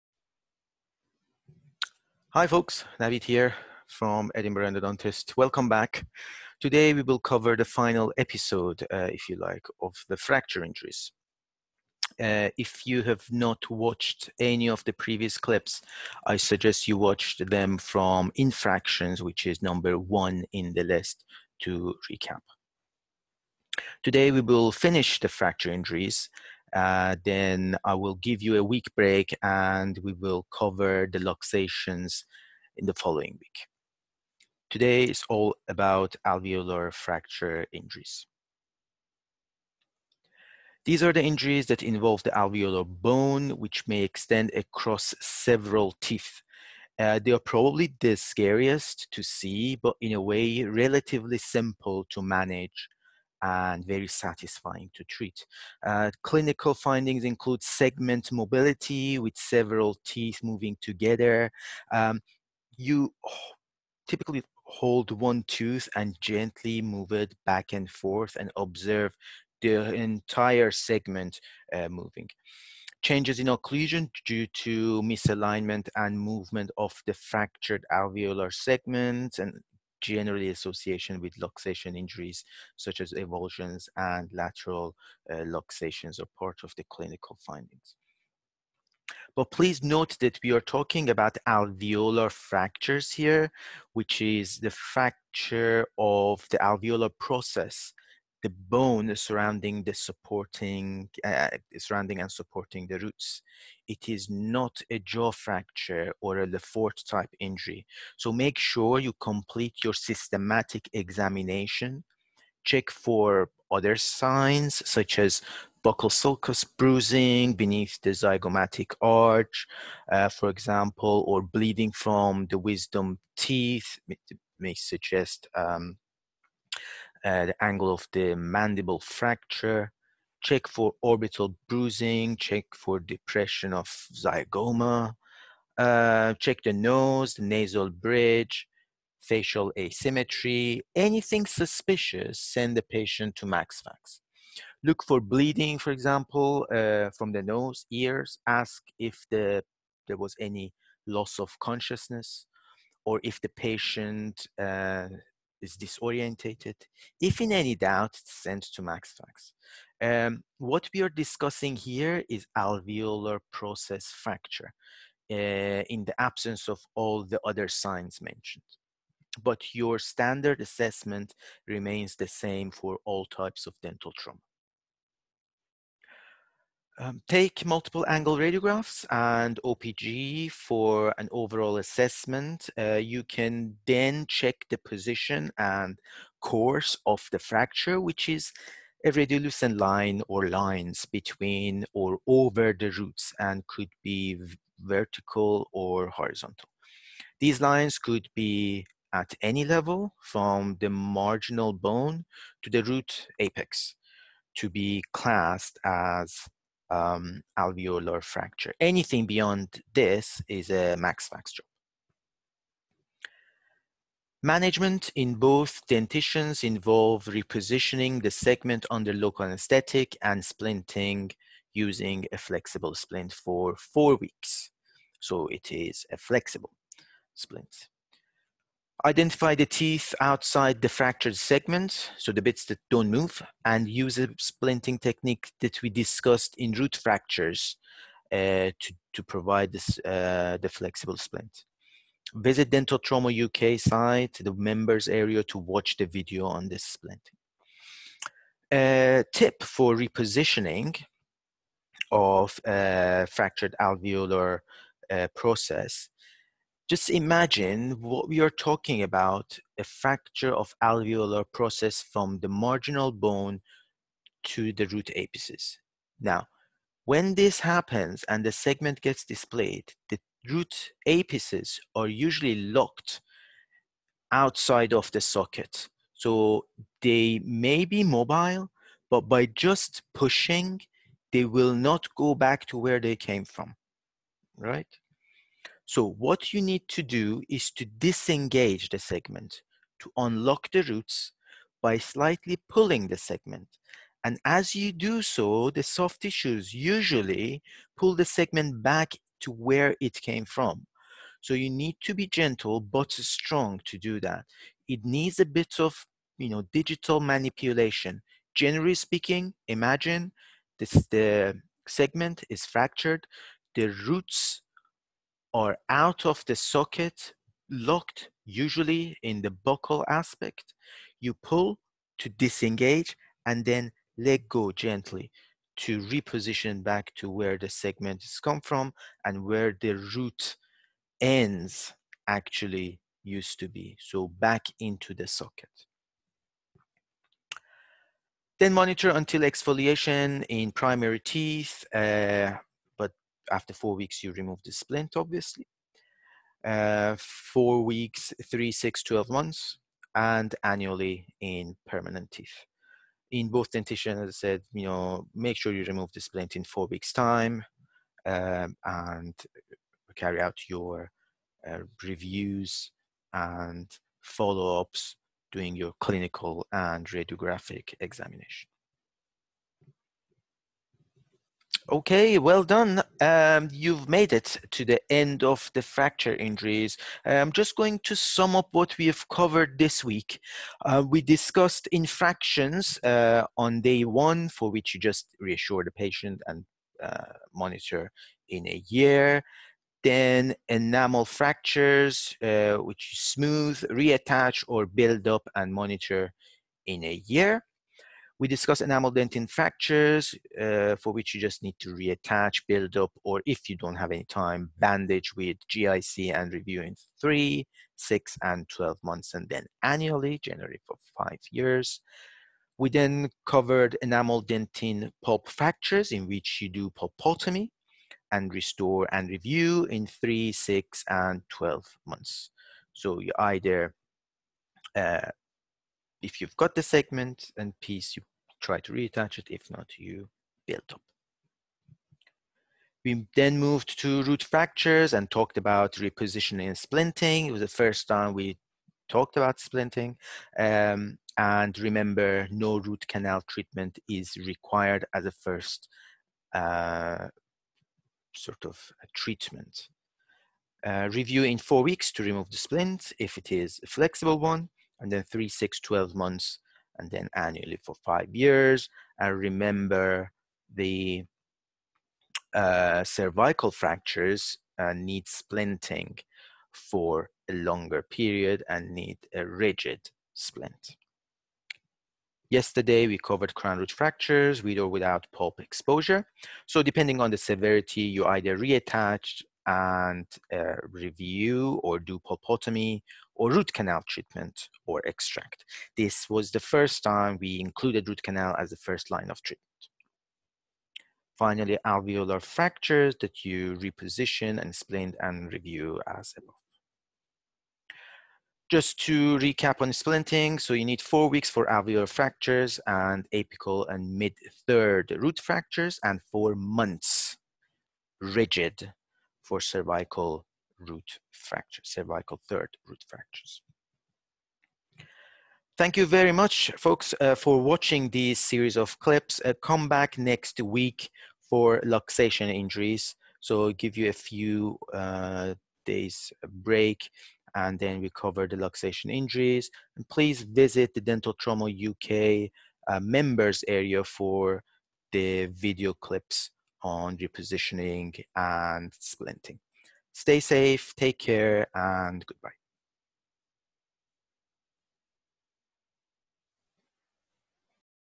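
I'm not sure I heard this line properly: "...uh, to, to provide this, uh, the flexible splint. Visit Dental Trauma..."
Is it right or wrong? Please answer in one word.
right.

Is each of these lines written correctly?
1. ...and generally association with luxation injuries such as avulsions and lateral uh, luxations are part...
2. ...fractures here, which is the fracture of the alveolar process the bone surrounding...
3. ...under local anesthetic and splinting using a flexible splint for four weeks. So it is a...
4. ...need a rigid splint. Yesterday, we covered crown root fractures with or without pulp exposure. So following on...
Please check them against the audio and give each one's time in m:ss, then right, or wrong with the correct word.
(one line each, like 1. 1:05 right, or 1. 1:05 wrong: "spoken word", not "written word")
1. 1:19 right
2. 1:32 right
3. 3:38 right
4. 7:48 wrong: "depending", not "following".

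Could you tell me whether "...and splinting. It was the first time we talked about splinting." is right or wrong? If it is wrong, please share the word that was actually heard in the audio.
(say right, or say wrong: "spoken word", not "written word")
right.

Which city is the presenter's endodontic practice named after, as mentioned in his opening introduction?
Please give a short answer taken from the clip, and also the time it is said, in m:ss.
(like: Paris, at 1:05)
Edinburgh, at 0:04.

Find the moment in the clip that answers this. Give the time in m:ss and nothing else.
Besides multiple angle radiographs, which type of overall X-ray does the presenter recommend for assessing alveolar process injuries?
2:59.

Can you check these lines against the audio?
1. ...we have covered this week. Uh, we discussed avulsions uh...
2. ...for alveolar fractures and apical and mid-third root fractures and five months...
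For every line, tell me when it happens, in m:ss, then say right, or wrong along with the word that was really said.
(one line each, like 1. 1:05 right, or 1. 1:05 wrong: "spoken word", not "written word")
1. 6:18 wrong: "infractions", not "avulsions"
2. 8:21 wrong: "four", not "five".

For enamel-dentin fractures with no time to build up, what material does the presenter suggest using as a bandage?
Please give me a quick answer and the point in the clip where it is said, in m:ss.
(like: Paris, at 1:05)
GIC, at 6:45.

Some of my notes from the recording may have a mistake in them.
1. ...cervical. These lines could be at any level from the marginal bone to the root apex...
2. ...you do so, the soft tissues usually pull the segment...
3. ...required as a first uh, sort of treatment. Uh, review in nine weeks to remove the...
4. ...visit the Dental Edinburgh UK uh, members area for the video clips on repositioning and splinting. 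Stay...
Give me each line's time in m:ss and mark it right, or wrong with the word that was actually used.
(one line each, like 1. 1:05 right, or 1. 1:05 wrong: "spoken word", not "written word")
1. 3:16 wrong: "horizontal", not "cervical"
2. 4:54 right
3. 7:24 wrong: "four", not "nine"
4. 8:50 wrong: "Trauma", not "Edinburgh".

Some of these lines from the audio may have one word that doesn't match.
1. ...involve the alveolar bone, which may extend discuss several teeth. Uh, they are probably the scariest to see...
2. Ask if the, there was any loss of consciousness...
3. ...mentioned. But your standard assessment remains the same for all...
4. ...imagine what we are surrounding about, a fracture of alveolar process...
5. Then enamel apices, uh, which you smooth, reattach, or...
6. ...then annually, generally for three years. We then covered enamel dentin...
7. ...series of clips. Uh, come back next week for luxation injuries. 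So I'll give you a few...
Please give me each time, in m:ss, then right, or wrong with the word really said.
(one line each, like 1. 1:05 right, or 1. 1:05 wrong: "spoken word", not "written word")
1. 0:41 wrong: "across", not "discuss"
2. 2:28 right
3. 2:48 right
4. 4:17 wrong: "talking", not "surrounding"
5. 6:30 wrong: "fractures", not "apices"
6. 6:49 wrong: "five", not "three"
7. 8:38 right.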